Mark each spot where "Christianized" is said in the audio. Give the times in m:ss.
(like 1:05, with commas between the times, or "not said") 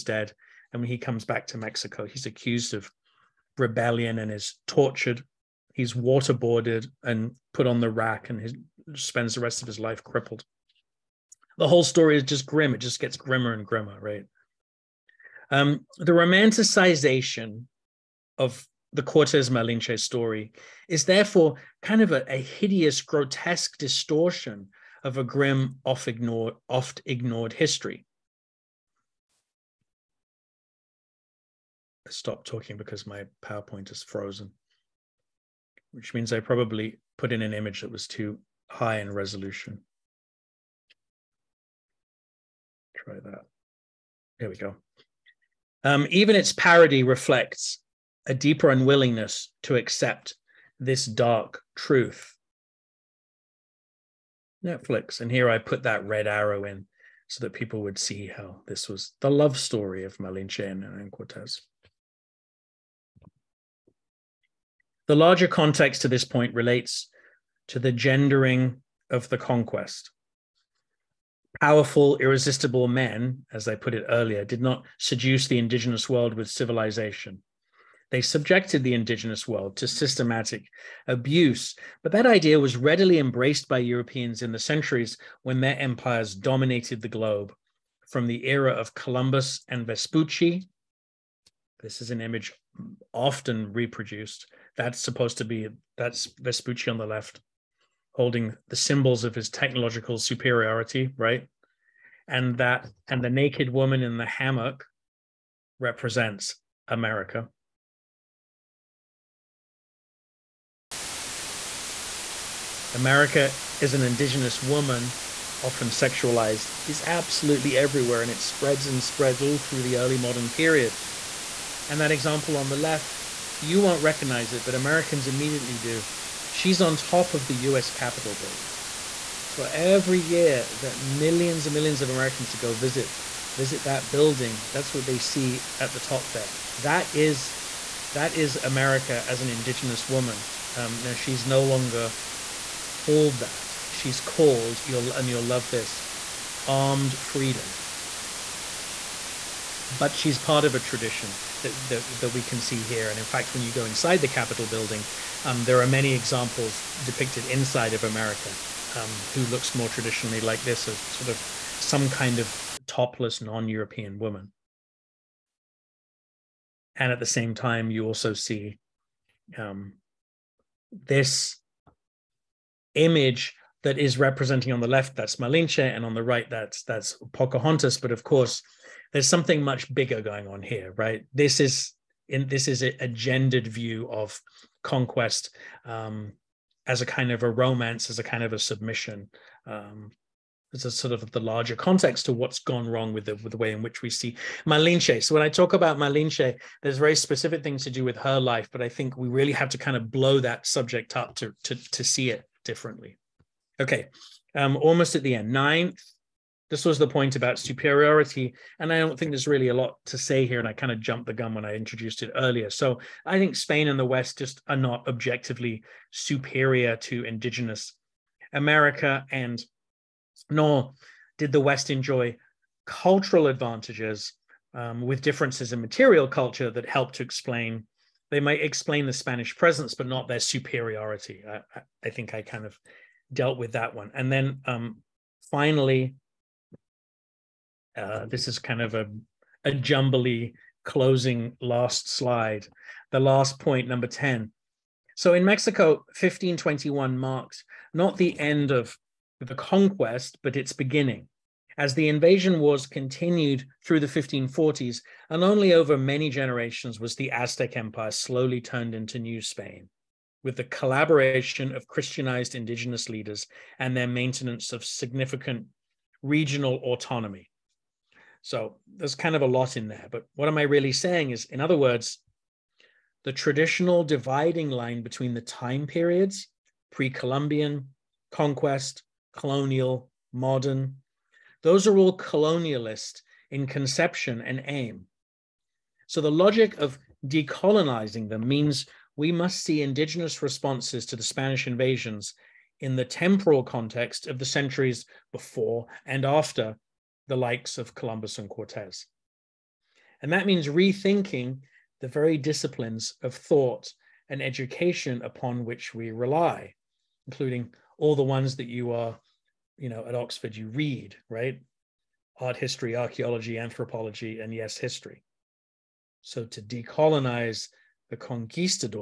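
4:21.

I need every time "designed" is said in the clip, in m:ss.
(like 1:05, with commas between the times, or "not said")
not said.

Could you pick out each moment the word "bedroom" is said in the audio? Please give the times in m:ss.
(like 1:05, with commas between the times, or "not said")
not said.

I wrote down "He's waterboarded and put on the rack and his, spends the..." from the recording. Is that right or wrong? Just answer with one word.
right.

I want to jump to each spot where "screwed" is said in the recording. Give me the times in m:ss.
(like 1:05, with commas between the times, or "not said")
not said.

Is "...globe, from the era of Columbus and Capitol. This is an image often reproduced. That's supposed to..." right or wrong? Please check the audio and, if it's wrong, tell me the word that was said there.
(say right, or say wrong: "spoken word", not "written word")
wrong: "Vespucci", not "Capitol".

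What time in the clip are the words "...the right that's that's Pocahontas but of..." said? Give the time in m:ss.
2:56.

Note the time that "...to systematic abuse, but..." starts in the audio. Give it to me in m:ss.
1:19.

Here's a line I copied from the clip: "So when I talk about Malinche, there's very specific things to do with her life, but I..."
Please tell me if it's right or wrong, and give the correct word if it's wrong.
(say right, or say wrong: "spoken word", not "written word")
right.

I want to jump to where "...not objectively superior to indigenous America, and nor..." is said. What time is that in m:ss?
3:34.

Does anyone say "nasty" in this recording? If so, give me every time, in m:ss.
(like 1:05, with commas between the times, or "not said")
not said.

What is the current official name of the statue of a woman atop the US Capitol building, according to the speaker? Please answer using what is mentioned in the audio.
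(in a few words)
Armed Freedom.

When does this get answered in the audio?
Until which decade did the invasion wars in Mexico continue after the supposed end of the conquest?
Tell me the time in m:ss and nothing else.
4:14.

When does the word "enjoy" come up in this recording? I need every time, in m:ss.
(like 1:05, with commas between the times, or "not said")
3:41.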